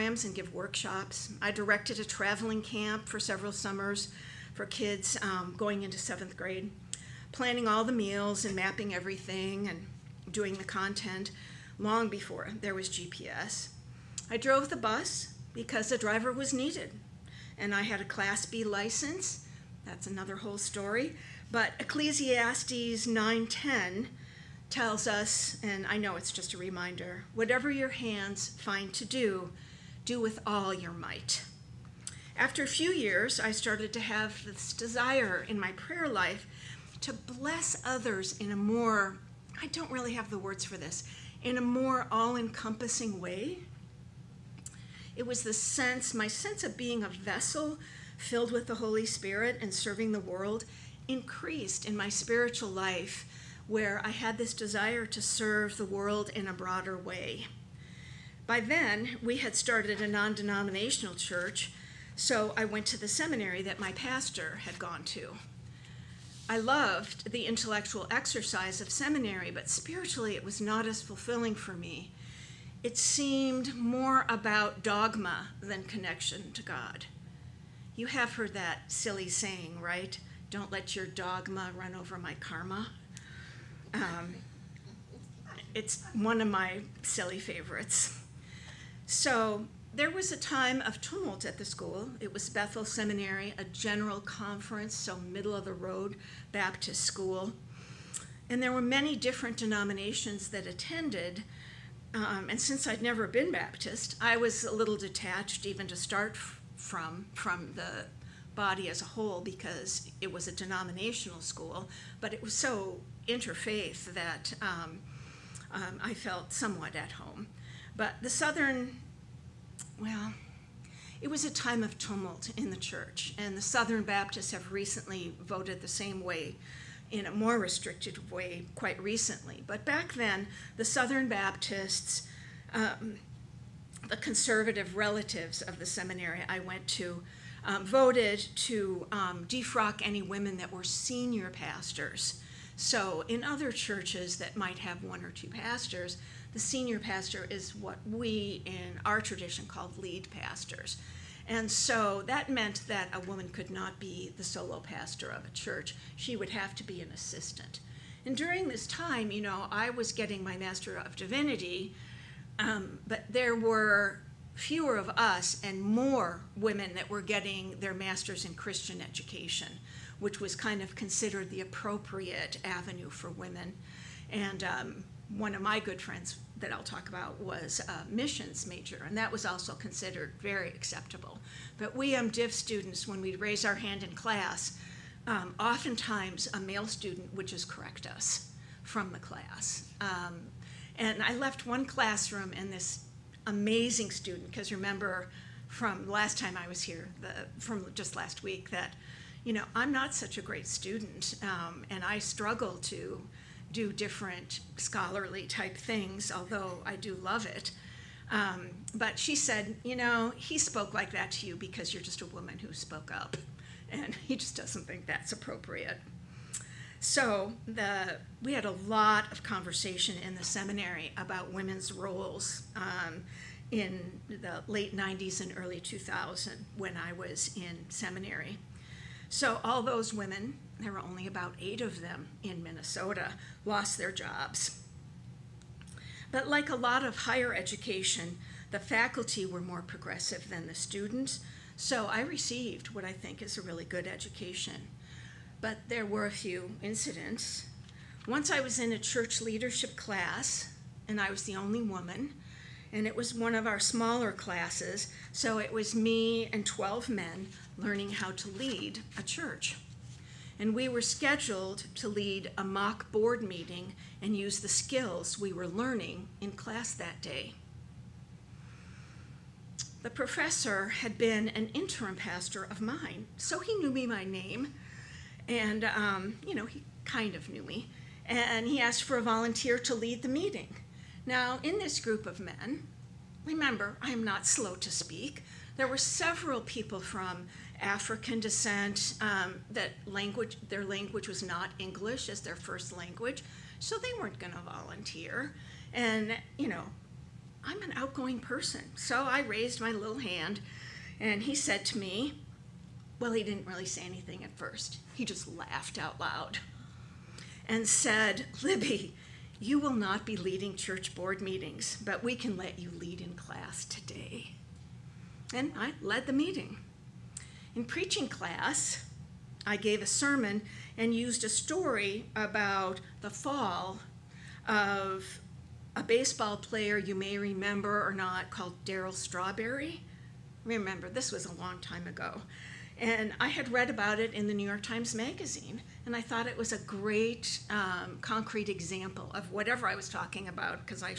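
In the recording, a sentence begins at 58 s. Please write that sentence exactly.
By then, we had started a non denominational church, so I went to the seminary that my pastor had gone to.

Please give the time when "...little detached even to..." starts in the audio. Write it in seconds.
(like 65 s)
104 s.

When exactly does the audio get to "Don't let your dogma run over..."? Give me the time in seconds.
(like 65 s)
80 s.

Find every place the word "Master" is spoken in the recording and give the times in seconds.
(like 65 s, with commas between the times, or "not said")
160 s, 167 s.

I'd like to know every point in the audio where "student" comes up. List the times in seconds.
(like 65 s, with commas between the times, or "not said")
182 s, 186 s, 194 s, 200 s, 240 s.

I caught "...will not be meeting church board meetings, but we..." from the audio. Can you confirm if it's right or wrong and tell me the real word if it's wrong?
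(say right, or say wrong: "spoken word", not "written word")
wrong: "leading", not "meeting".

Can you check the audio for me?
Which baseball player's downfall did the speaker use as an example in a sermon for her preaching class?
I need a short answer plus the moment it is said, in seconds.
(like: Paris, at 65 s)
Darryl Strawberry, at 328 s.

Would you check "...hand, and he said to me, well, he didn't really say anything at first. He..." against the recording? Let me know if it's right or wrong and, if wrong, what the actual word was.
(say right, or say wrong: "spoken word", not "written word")
right.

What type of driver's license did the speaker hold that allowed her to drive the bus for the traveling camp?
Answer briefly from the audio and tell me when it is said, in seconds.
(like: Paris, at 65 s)
Class B, at 18 s.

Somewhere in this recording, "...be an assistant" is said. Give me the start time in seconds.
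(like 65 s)
156 s.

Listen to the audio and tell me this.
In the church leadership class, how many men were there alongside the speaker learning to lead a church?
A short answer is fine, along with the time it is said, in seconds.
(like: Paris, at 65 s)
12, at 256 s.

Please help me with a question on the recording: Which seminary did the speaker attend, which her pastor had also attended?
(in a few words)
Bethel Seminary.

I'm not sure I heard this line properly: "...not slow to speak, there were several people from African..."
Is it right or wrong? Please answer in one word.
right.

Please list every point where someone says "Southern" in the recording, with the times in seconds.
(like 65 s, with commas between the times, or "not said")
118 s, 123 s, 130 s.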